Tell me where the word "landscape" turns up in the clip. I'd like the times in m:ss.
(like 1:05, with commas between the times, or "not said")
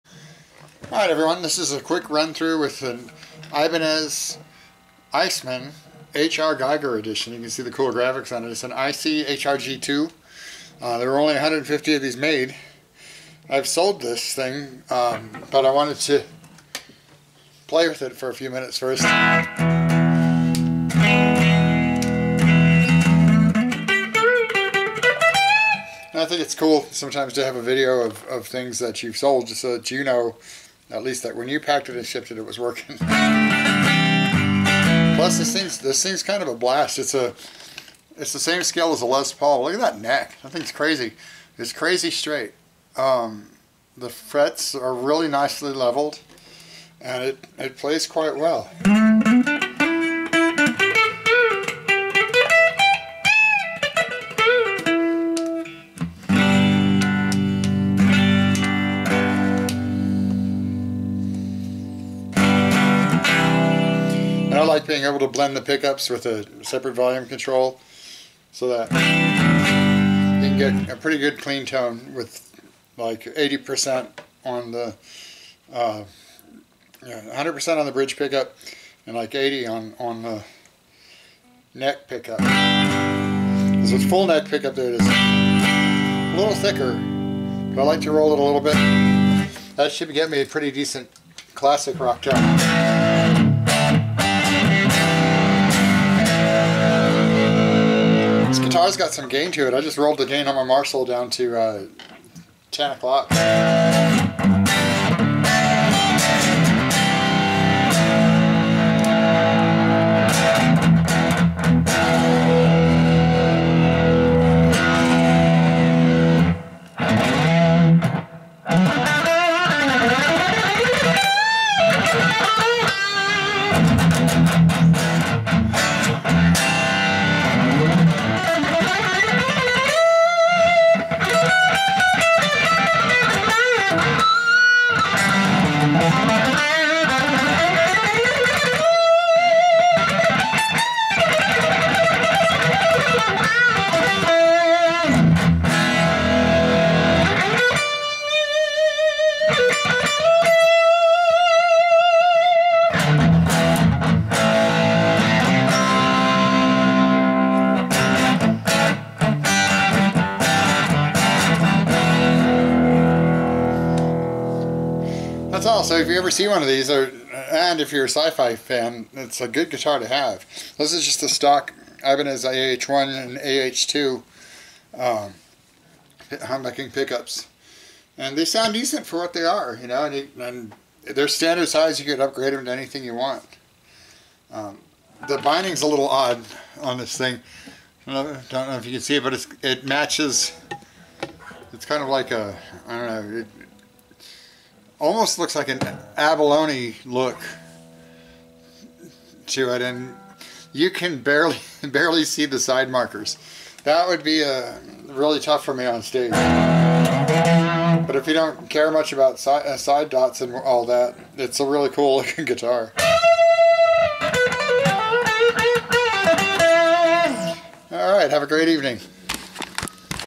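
not said.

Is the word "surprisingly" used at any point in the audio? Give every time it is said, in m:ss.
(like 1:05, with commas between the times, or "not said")
not said.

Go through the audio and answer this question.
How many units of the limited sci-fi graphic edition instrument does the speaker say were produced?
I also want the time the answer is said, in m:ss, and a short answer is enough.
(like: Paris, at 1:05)
150, at 0:11.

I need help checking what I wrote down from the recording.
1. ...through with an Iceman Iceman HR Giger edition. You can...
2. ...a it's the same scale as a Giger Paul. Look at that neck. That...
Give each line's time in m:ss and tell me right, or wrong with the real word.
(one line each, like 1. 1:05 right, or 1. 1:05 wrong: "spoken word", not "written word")
1. 0:02 wrong: "Ibanez", not "Iceman"
2. 0:37 wrong: "Les", not "Giger".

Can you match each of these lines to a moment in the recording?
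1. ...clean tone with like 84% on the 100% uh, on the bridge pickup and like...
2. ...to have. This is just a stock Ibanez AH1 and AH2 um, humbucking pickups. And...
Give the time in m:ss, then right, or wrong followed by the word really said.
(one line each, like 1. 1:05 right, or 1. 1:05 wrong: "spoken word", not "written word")
1. 1:11 wrong: "80", not "84"
2. 2:49 right.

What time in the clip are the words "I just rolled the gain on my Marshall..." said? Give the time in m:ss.
1:39.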